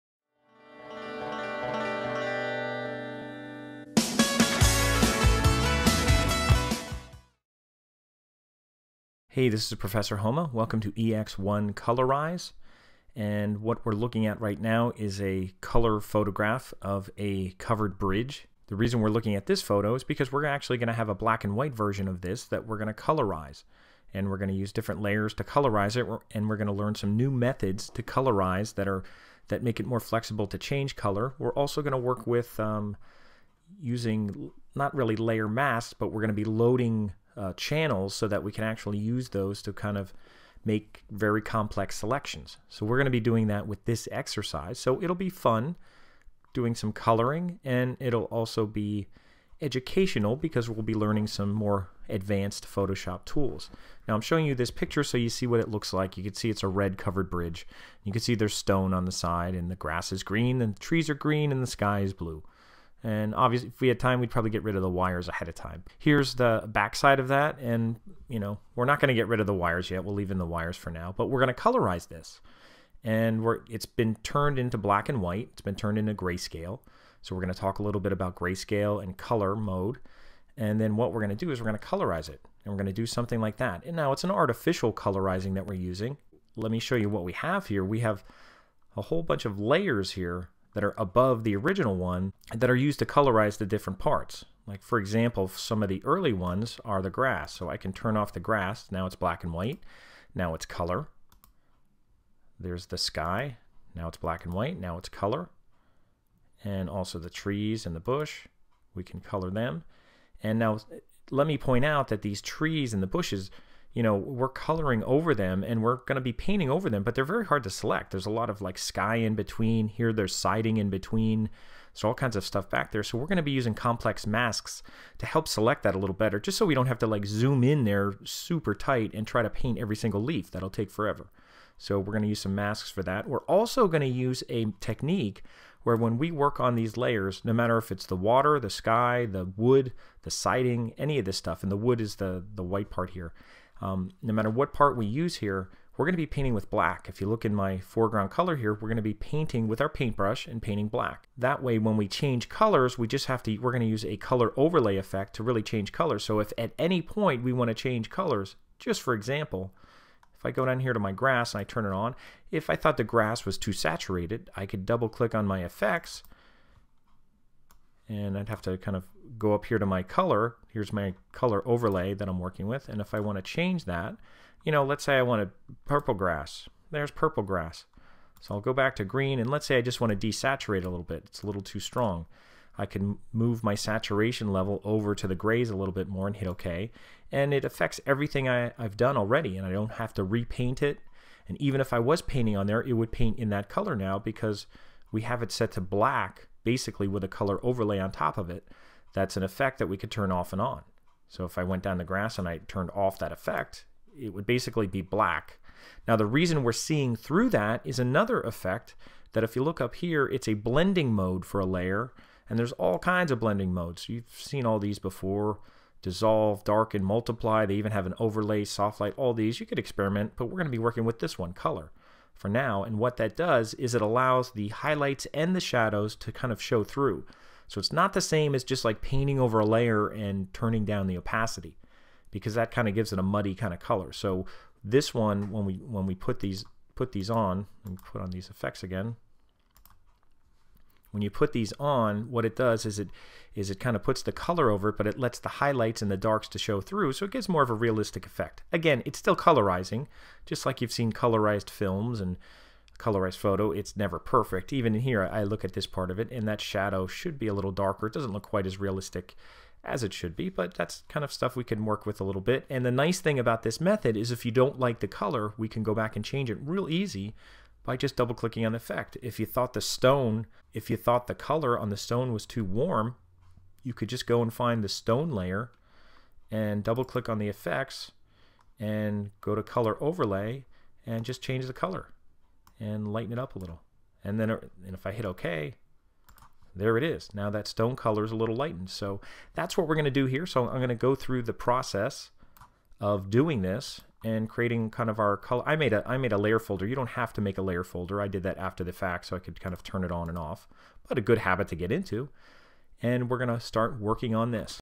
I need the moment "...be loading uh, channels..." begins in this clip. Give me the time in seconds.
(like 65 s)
36 s.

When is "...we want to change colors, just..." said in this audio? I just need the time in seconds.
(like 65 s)
157 s.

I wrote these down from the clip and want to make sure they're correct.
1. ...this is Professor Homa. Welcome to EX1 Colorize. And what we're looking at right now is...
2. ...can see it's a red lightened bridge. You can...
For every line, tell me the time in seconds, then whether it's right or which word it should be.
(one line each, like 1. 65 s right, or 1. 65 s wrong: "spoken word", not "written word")
1. 9 s right
2. 56 s wrong: "covered", not "lightened".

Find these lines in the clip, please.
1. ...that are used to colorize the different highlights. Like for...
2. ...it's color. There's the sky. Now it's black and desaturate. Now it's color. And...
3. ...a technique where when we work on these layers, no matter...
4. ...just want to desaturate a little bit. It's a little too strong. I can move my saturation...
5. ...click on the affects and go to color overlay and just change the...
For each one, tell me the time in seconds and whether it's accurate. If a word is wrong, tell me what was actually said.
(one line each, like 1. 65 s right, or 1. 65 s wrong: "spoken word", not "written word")
1. 92 s wrong: "parts", not "highlights"
2. 100 s wrong: "white", not "desaturate"
3. 134 s right
4. 179 s right
5. 277 s wrong: "effects", not "affects".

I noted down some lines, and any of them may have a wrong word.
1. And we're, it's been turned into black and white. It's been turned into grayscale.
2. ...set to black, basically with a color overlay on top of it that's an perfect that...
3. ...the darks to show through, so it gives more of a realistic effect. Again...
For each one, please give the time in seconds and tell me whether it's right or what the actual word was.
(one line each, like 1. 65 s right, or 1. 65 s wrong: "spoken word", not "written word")
1. 73 s right
2. 195 s wrong: "effect", not "perfect"
3. 246 s right.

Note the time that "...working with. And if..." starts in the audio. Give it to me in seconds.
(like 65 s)
172 s.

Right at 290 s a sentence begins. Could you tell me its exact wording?
So I'm going to go through the process of doing this and creating kind of our color.